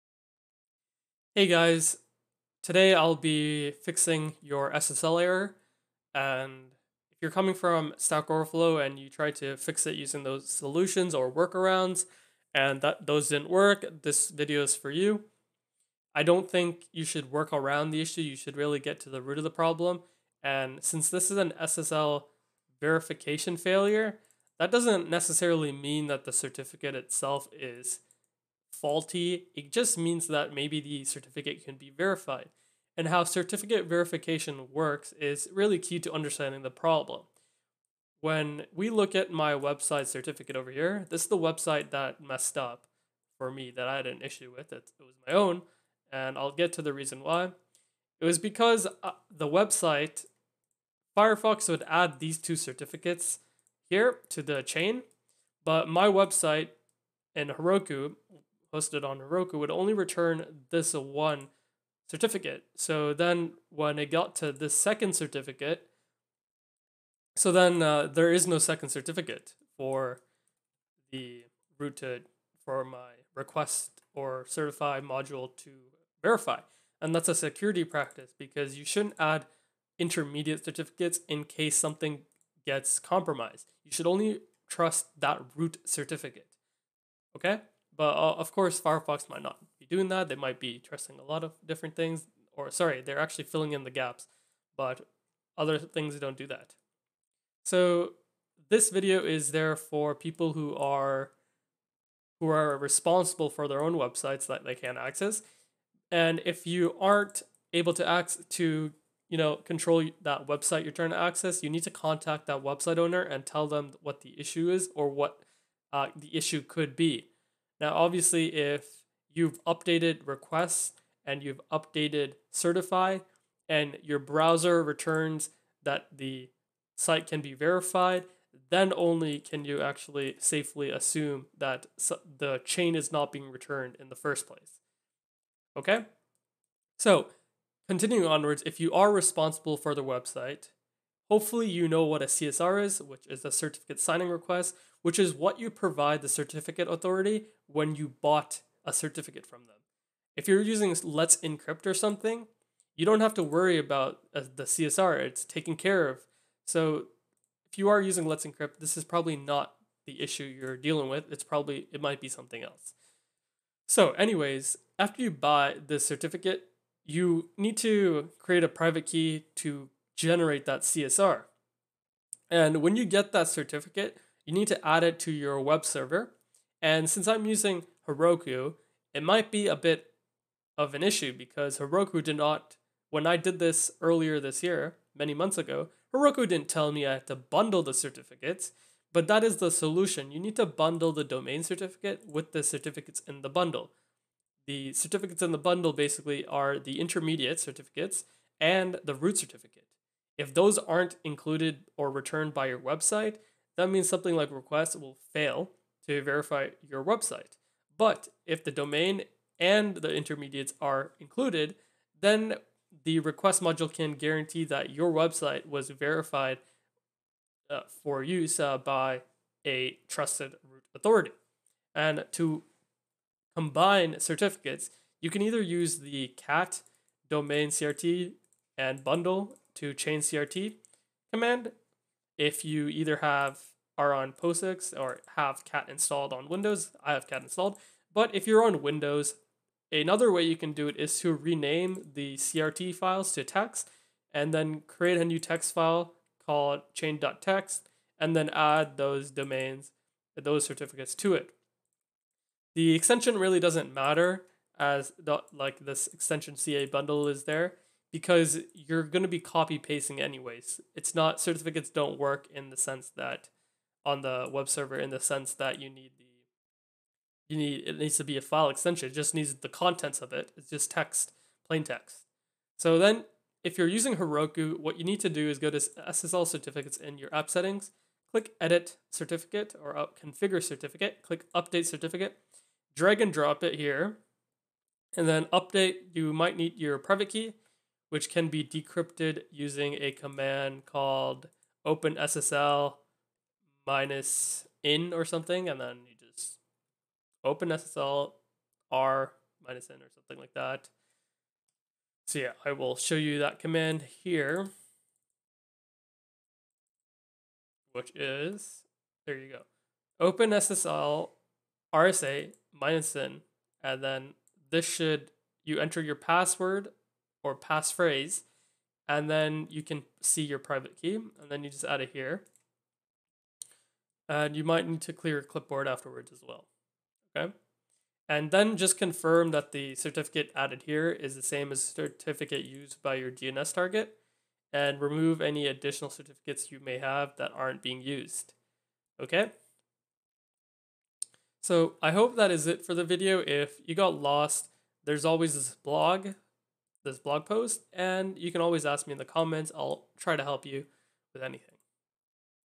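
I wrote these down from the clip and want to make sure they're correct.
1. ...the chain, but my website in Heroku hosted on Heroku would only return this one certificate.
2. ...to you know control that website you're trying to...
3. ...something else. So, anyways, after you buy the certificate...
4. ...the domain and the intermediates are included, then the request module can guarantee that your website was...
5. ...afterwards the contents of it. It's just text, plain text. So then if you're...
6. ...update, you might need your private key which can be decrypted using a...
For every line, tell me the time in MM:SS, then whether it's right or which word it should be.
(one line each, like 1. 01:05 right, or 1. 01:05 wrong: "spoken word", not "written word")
1. 00:54 right
2. 01:48 right
3. 02:42 right
4. 03:28 right
5. 04:29 wrong: "needs", not "afterwards"
6. 04:45 right.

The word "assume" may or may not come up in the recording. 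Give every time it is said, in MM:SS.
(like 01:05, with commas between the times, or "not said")
02:10.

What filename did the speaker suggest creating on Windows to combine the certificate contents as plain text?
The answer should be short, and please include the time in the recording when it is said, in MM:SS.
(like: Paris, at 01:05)
chain.txt, at 04:06.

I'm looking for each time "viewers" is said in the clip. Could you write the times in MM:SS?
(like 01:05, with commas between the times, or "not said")
not said.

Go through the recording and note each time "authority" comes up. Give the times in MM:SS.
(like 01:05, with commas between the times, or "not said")
02:26, 03:40.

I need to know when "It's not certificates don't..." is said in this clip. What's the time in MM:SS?
04:20.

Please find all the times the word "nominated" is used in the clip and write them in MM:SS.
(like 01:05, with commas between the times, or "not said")
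not said.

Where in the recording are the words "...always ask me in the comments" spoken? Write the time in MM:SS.
05:48.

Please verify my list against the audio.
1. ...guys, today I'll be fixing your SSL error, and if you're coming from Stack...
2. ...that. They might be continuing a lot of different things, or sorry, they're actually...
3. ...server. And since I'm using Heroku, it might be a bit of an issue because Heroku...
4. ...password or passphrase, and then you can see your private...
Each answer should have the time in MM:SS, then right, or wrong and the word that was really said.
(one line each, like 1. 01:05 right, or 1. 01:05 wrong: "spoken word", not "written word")
1. 00:01 right
2. 01:30 wrong: "trusting", not "continuing"
3. 02:55 right
4. 05:16 right.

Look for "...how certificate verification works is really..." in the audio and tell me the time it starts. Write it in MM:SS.
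00:33.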